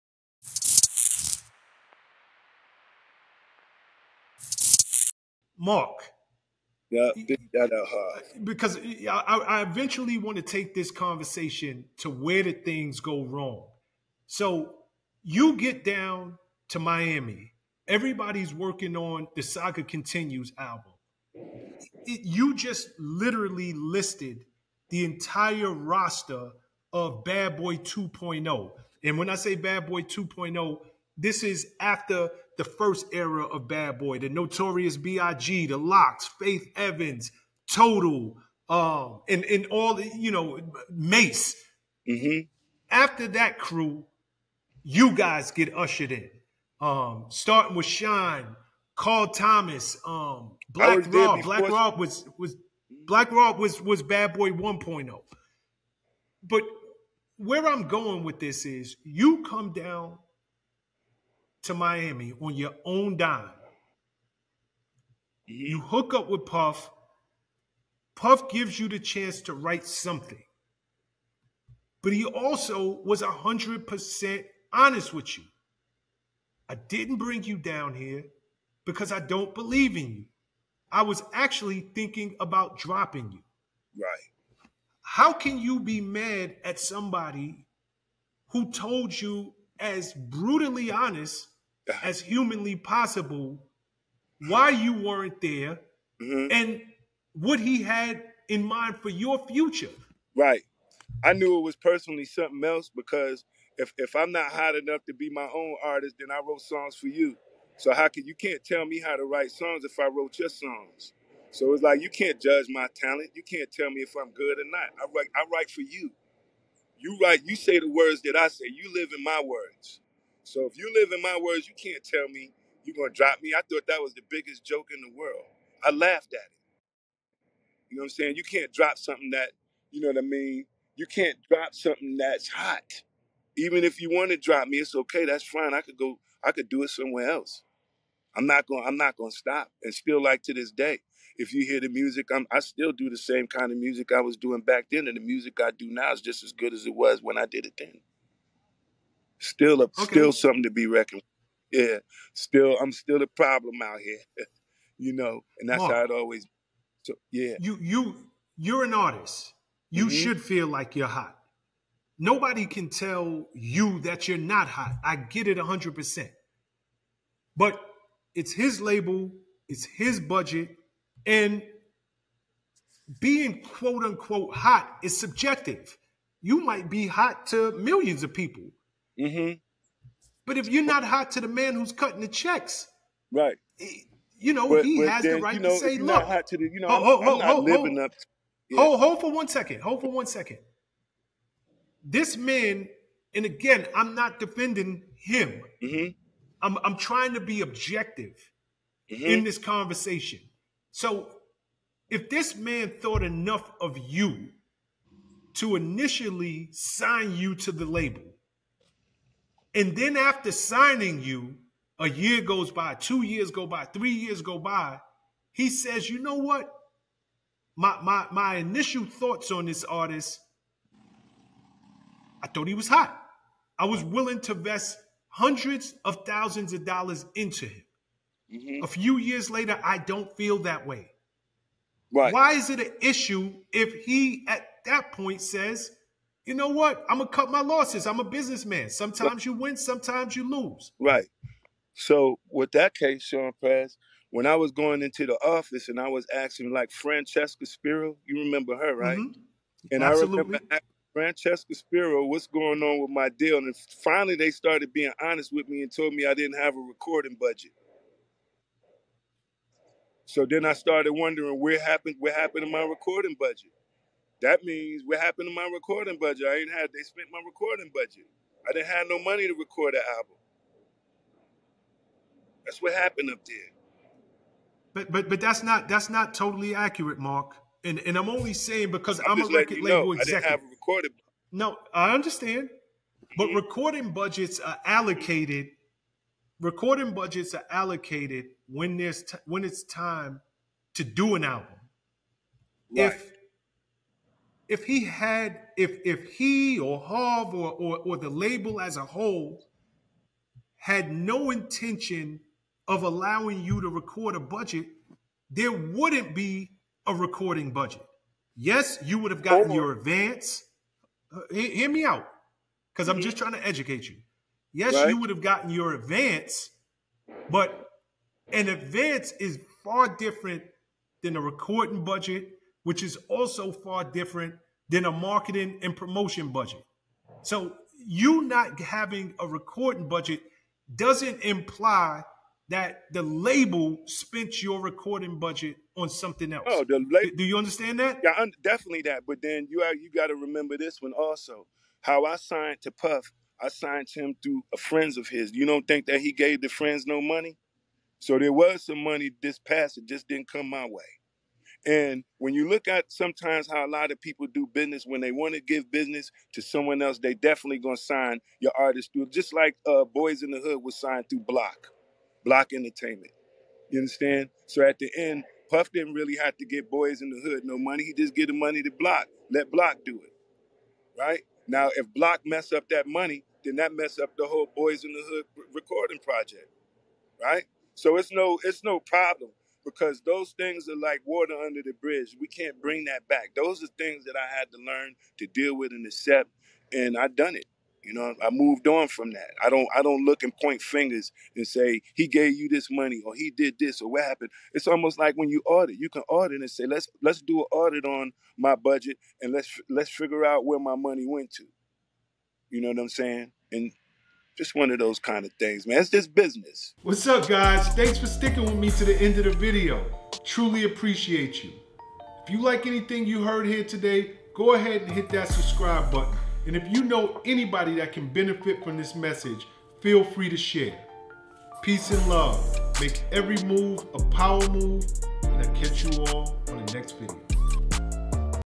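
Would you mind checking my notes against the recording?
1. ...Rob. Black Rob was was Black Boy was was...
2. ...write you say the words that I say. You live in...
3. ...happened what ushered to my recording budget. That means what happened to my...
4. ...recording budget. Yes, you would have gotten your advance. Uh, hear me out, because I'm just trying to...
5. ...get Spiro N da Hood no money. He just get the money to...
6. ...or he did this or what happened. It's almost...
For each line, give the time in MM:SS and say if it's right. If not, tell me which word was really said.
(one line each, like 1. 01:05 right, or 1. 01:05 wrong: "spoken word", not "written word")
1. 00:51 wrong: "Rob", not "Boy"
2. 01:57 right
3. 04:21 wrong: "happened", not "ushered"
4. 05:07 right
5. 06:06 wrong: "Boyz", not "Spiro"
6. 06:33 right.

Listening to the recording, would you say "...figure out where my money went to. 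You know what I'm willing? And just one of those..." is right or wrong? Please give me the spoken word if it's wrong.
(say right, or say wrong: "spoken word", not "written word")
wrong: "saying", not "willing".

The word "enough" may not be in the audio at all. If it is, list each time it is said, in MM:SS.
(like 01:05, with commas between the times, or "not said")
01:44, 03:23.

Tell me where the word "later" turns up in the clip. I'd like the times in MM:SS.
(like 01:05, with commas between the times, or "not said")
03:49.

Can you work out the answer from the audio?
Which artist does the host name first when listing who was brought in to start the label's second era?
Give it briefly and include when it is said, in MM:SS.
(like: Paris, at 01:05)
Shyne, at 00:47.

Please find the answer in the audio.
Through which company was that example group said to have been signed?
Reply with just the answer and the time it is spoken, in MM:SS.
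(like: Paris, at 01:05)
Block Entertainment, at 06:02.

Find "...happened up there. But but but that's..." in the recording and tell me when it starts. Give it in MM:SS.
04:32.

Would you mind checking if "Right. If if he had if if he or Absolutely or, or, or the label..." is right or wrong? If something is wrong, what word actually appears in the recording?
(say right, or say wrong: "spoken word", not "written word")
wrong: "Harve", not "Absolutely".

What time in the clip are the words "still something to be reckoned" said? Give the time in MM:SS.
02:30.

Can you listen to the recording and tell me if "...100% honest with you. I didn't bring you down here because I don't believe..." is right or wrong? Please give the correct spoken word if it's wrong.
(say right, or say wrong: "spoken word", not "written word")
right.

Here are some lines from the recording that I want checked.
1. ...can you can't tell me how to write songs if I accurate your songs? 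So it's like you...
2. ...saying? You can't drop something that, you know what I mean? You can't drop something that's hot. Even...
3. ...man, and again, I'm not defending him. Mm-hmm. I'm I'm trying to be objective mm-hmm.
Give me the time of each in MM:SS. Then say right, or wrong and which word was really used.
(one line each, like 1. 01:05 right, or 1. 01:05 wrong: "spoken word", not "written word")
1. 01:48 wrong: "wrote", not "accurate"
2. 02:08 right
3. 03:12 right.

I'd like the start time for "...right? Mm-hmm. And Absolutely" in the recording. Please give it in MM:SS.
04:08.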